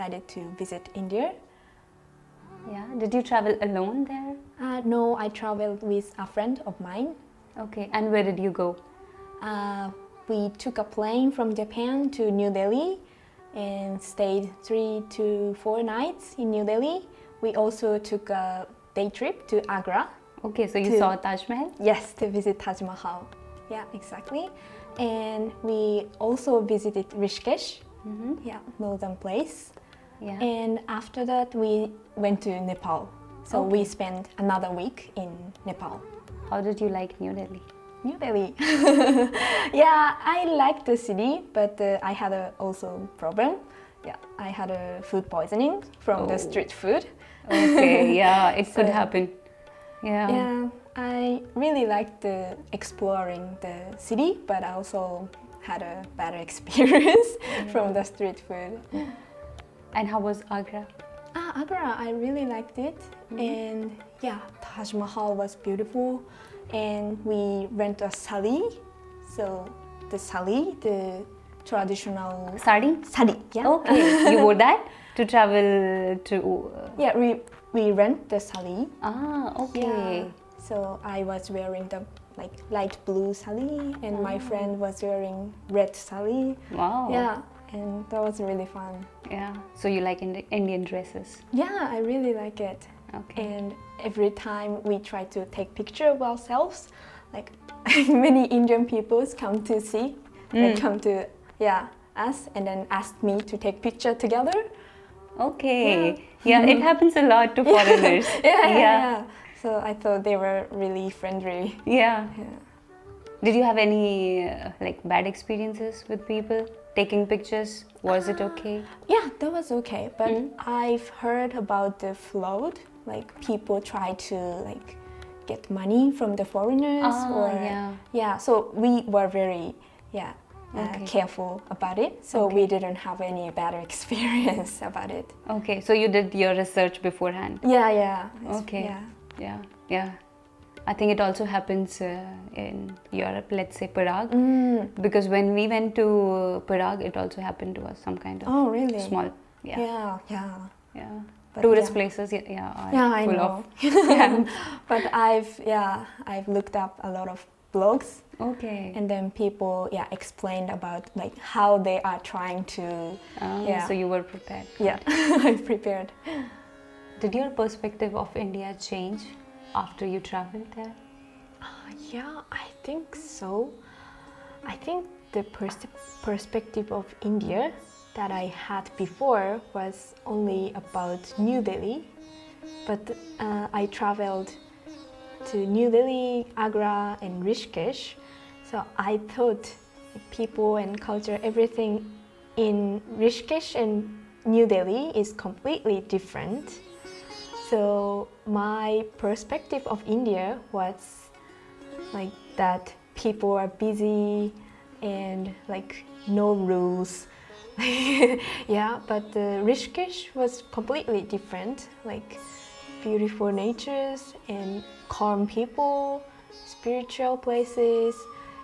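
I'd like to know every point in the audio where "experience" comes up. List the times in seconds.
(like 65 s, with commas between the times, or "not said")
56 s, 115 s, 133 s.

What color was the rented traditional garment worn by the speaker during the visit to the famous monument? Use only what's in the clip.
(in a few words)
Light blue.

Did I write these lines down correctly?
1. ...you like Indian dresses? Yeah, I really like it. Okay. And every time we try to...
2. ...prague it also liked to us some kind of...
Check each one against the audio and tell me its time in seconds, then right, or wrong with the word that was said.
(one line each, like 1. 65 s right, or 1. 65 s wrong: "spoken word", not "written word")
1. 89 s right
2. 146 s wrong: "happened", not "liked".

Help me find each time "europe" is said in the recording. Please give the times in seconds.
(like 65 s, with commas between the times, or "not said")
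143 s.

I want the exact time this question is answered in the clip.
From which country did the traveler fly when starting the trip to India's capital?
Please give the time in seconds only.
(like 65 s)
11 s.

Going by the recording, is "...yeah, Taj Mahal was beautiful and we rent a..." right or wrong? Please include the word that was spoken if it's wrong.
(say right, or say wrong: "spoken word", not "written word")
right.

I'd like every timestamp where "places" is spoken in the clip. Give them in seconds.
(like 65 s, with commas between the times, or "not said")
29 s, 151 s, 217 s.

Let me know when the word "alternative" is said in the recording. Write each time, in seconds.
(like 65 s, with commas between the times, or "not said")
not said.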